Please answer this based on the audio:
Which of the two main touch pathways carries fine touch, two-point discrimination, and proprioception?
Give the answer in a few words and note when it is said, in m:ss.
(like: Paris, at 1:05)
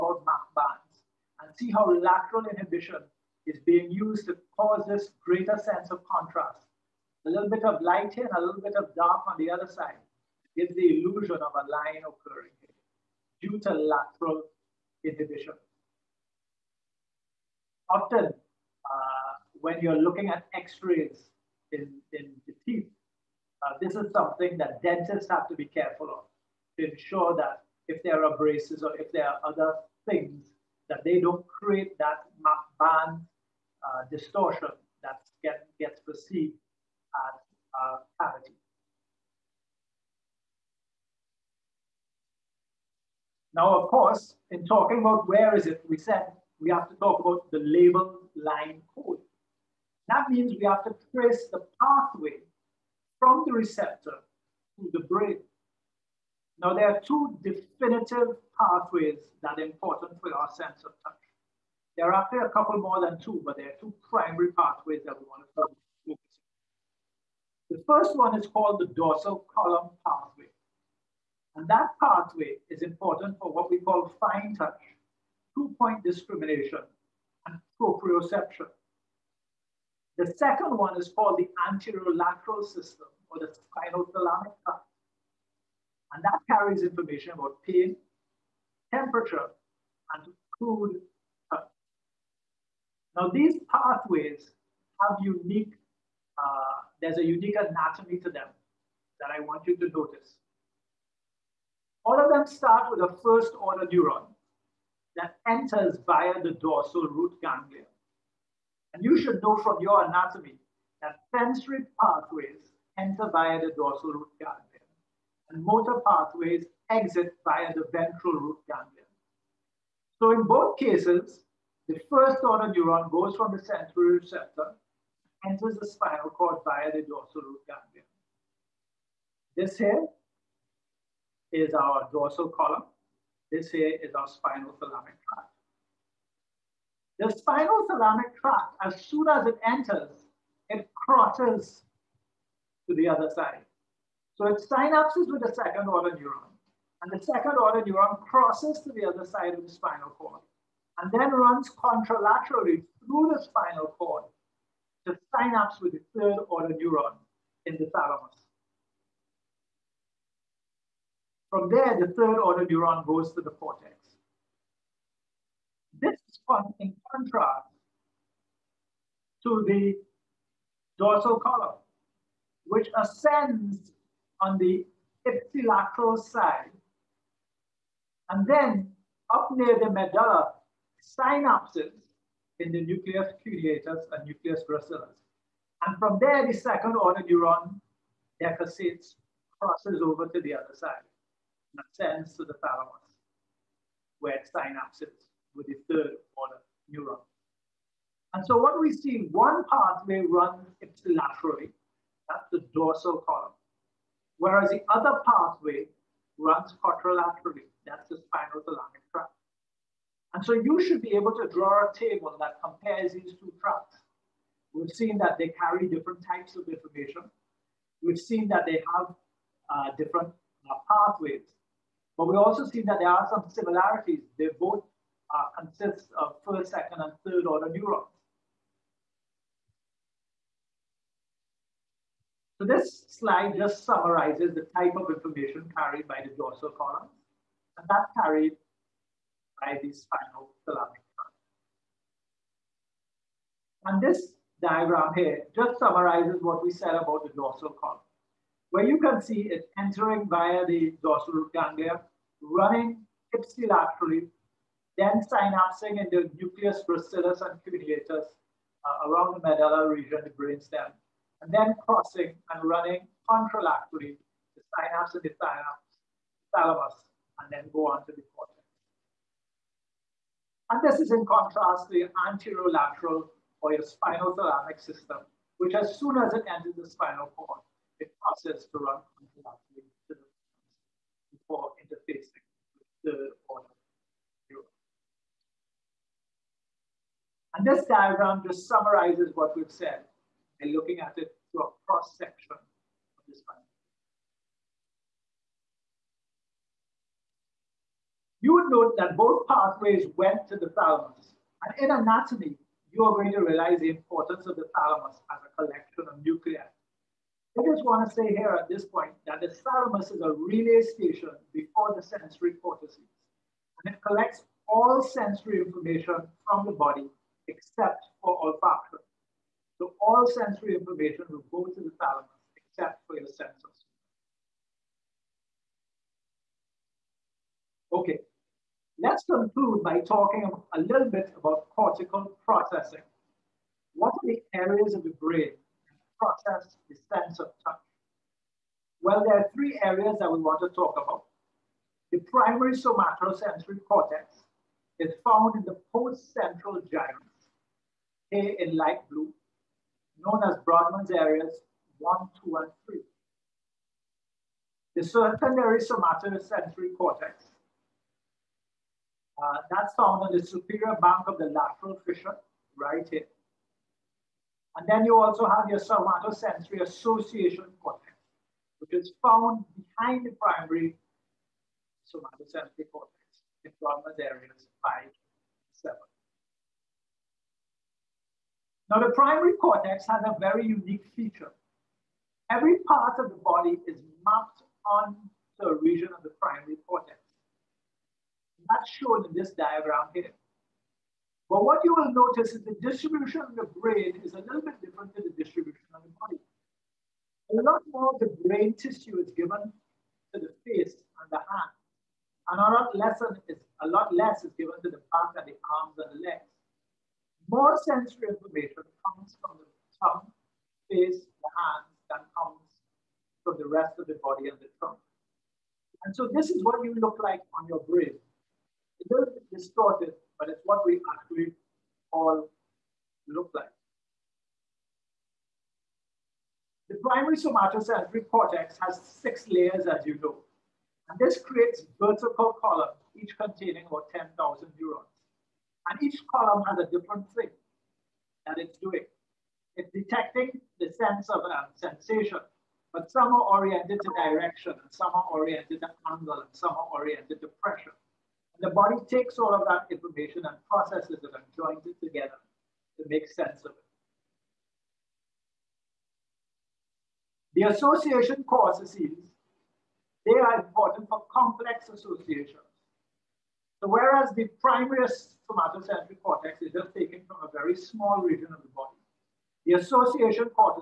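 dorsal column pathway, at 1:08.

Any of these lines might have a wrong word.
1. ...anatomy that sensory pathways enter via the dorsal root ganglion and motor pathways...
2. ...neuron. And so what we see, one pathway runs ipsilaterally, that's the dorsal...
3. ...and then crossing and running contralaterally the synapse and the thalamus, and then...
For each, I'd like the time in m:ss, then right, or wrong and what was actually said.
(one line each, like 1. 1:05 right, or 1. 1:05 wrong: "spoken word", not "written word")
1. 1:50 right
2. 3:16 right
3. 4:21 right.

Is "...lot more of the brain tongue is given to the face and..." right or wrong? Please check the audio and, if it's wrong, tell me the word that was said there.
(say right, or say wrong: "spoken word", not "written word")
wrong: "tissue", not "tongue".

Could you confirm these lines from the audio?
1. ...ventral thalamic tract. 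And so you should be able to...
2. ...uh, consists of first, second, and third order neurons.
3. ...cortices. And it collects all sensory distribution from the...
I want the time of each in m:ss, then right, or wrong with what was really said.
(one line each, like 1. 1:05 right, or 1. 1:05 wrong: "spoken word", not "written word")
1. 3:28 wrong: "spinal", not "ventral"
2. 3:45 right
3. 5:12 wrong: "information", not "distribution".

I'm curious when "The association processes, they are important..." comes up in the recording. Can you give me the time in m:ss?
7:37.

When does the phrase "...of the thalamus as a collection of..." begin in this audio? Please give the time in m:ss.
5:04.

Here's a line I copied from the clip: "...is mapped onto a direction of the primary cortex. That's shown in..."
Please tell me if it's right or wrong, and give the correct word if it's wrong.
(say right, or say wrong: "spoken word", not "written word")
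wrong: "region", not "direction".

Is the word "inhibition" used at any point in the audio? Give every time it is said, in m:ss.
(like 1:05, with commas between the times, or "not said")
0:02, 0:15.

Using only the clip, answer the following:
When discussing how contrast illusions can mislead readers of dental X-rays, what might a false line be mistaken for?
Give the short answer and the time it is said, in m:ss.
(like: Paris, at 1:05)
cavity, at 0:38.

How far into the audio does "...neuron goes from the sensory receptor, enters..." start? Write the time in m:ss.
2:02.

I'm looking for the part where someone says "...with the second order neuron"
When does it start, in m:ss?
2:25.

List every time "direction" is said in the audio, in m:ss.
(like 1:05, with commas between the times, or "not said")
7:24.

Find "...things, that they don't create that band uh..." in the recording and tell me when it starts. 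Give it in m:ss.
0:30.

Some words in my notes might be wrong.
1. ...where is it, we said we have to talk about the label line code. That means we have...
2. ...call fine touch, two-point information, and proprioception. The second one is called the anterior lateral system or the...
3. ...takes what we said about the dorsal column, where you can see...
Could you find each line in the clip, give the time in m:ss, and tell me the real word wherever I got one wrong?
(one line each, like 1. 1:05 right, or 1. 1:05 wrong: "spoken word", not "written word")
1. 0:45 right
2. 1:13 wrong: "discrimination", not "information"
3. 4:05 wrong: "summarizes", not "takes".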